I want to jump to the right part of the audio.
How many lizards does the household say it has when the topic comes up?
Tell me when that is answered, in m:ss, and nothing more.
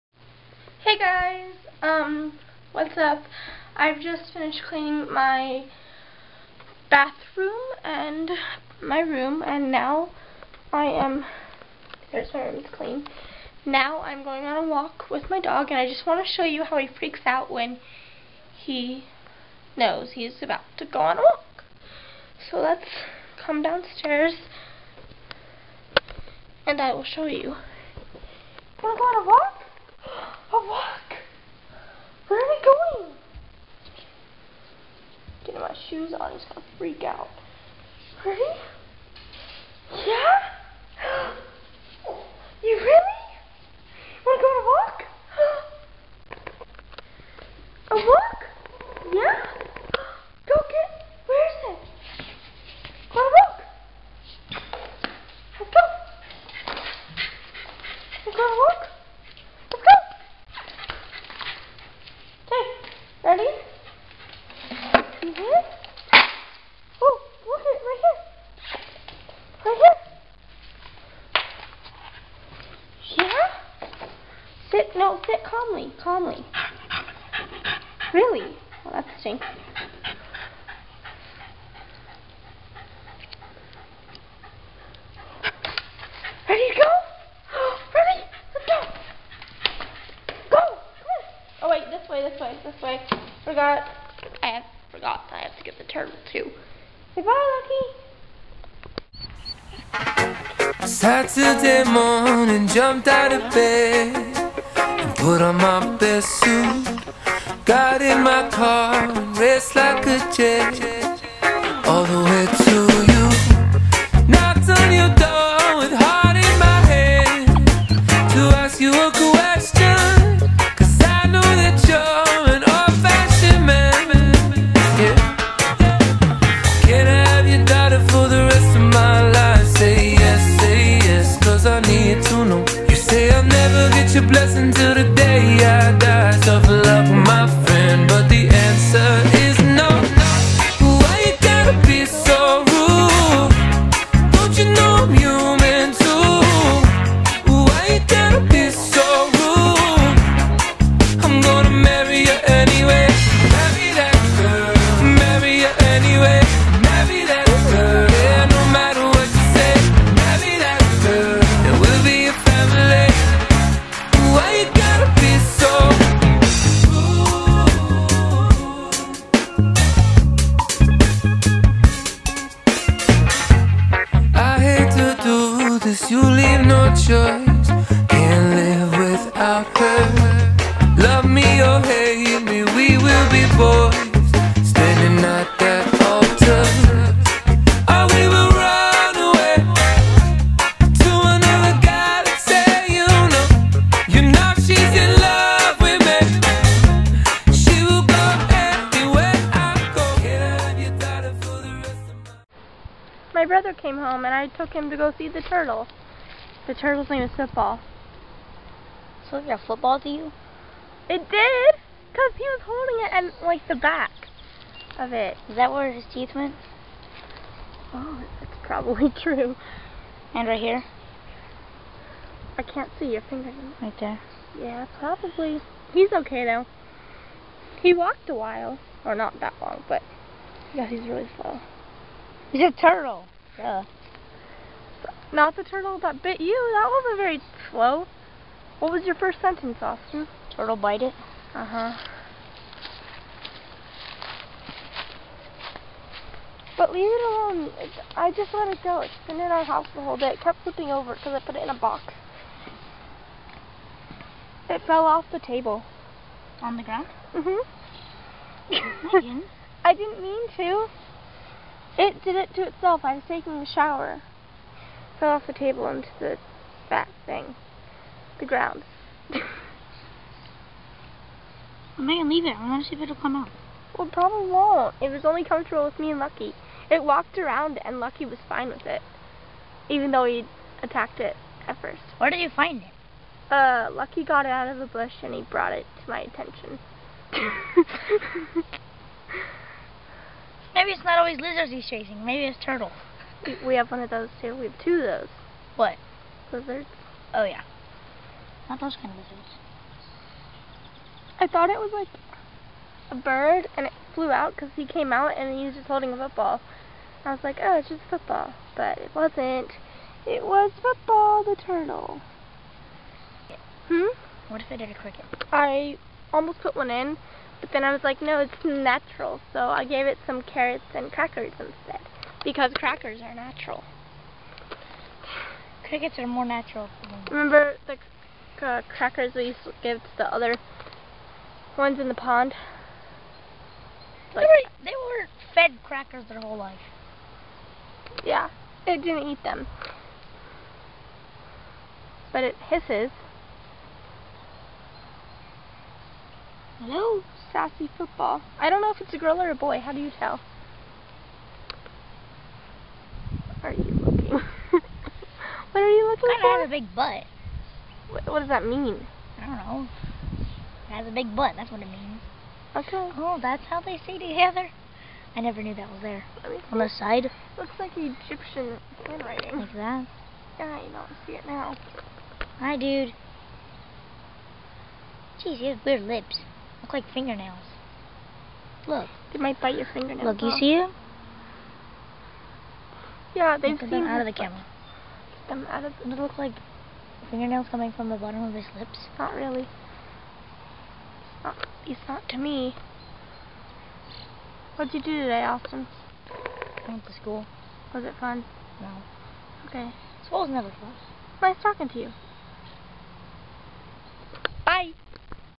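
4:54.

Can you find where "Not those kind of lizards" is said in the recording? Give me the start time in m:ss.
4:58.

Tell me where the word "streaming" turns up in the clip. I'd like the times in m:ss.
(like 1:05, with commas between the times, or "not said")
not said.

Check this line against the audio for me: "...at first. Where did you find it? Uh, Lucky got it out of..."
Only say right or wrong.
right.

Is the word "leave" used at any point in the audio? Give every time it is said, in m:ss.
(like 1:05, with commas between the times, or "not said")
4:06, 4:32.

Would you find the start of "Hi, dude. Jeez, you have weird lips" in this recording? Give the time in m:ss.
6:12.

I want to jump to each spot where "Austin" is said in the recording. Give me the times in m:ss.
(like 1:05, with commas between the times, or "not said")
3:59, 6:35.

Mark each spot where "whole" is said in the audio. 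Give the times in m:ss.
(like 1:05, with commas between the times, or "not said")
4:10, 5:36.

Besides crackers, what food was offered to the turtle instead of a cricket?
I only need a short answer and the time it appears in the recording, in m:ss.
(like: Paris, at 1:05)
carrots, at 5:20.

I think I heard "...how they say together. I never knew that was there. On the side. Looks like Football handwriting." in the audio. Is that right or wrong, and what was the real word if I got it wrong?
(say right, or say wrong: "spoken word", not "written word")
wrong: "Egyptian", not "Football".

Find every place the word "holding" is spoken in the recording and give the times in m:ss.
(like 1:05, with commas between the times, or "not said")
3:32, 5:05.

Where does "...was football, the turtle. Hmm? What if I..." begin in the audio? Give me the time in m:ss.
5:10.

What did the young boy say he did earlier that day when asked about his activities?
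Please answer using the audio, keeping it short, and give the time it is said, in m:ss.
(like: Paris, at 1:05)
went to school, at 6:36.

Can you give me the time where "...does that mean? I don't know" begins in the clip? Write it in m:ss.
5:58.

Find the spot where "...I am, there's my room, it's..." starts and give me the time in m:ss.
0:10.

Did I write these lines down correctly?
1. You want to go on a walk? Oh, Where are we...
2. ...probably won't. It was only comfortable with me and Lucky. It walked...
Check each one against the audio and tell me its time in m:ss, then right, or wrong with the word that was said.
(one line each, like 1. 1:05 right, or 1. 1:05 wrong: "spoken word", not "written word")
1. 0:27 right
2. 4:34 right.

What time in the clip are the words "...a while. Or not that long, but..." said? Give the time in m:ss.
3:48.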